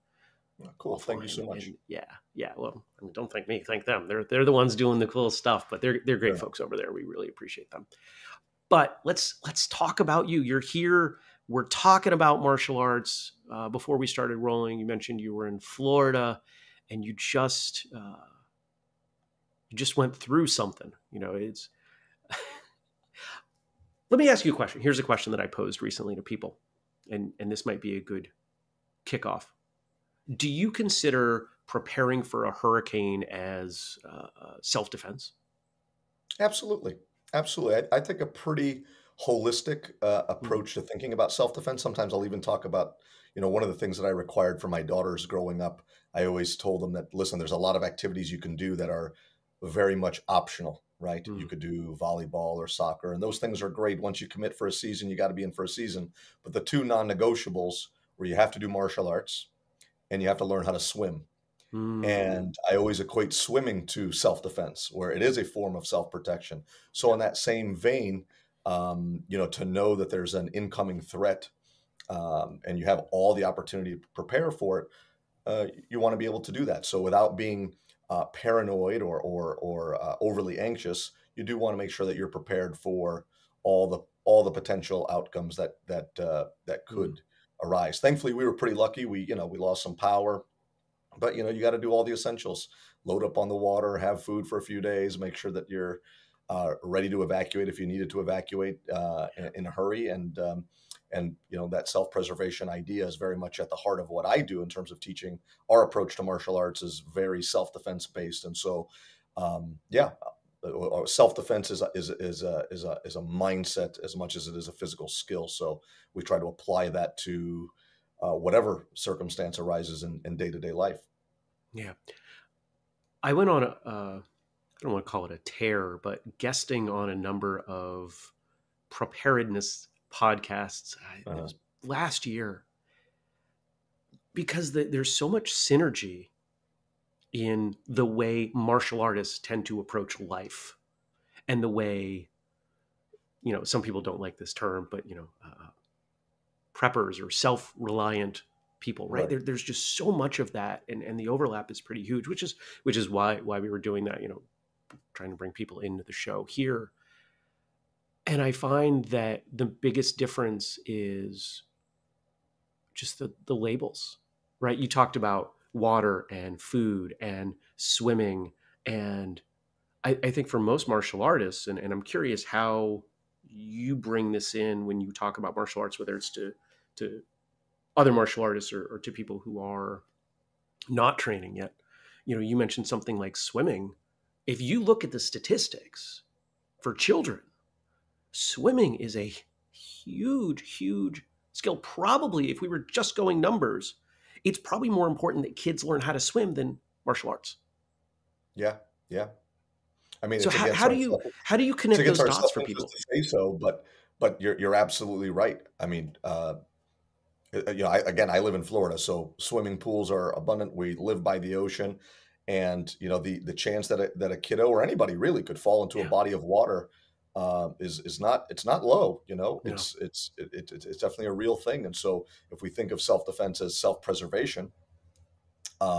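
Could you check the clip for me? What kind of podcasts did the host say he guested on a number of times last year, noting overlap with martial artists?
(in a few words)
Preparedness podcasts.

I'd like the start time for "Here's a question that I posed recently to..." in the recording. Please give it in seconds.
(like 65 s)
24 s.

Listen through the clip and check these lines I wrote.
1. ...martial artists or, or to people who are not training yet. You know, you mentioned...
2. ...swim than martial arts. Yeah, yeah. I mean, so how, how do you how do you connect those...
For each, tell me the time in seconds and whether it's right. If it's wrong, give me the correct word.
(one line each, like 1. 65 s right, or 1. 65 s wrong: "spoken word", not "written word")
1. 178 s right
2. 196 s right.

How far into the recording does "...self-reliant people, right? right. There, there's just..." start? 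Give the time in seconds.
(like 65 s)
147 s.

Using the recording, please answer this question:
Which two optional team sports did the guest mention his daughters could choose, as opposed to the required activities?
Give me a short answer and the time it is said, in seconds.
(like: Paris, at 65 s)
Volleyball or soccer, at 51 s.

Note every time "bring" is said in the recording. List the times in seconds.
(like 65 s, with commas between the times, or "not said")
155 s, 173 s.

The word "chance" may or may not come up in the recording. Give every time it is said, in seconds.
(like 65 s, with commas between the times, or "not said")
213 s.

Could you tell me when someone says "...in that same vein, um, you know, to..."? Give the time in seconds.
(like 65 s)
67 s.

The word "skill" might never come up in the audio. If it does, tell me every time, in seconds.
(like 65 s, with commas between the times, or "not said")
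115 s, 191 s.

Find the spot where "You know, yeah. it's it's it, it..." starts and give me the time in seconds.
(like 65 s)
219 s.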